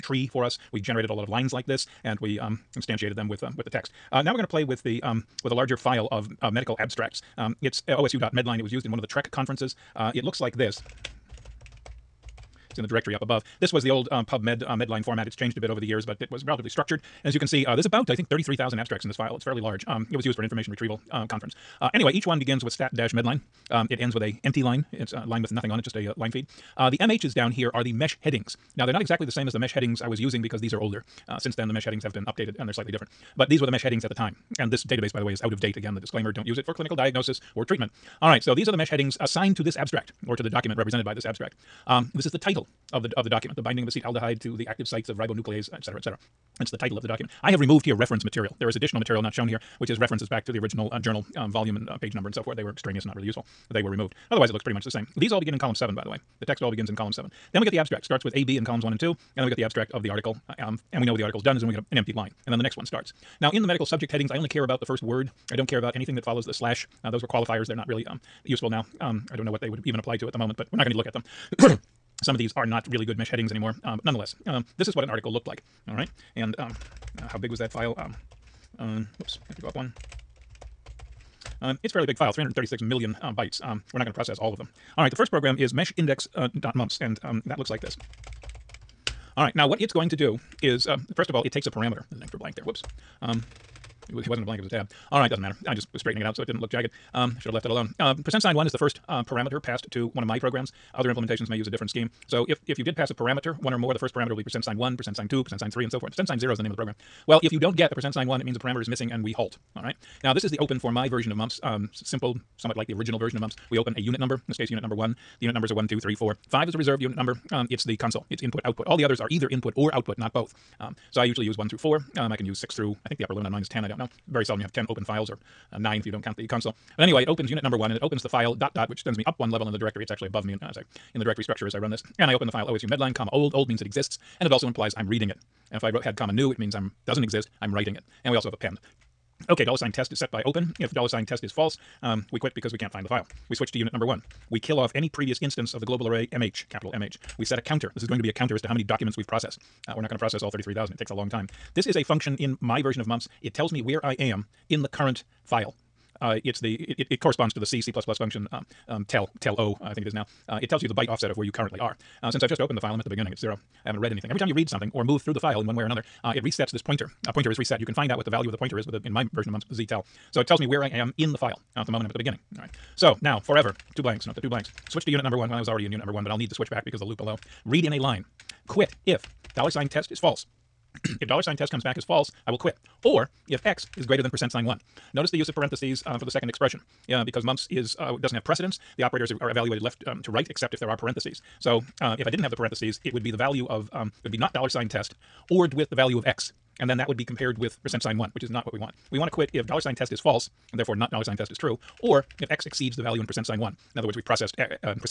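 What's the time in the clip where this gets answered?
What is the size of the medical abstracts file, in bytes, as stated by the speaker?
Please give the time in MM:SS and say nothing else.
01:22.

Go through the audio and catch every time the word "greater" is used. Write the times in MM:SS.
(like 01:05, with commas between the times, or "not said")
03:04.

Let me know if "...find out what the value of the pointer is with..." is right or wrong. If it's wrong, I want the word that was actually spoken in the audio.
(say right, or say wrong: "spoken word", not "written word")
right.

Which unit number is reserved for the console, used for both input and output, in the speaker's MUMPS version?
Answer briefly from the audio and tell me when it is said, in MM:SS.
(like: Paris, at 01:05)
5, at 01:56.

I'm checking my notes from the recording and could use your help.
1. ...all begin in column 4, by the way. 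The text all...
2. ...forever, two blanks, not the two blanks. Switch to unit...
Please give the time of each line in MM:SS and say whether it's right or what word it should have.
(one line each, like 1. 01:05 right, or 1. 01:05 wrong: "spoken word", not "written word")
1. 00:55 wrong: "7", not "4"
2. 02:53 right.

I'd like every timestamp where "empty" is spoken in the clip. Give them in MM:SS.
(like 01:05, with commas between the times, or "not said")
00:24, 01:01.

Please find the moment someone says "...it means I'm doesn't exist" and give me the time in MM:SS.
02:16.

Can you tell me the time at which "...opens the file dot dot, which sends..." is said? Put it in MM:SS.
02:08.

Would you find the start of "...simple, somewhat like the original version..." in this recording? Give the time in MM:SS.
01:51.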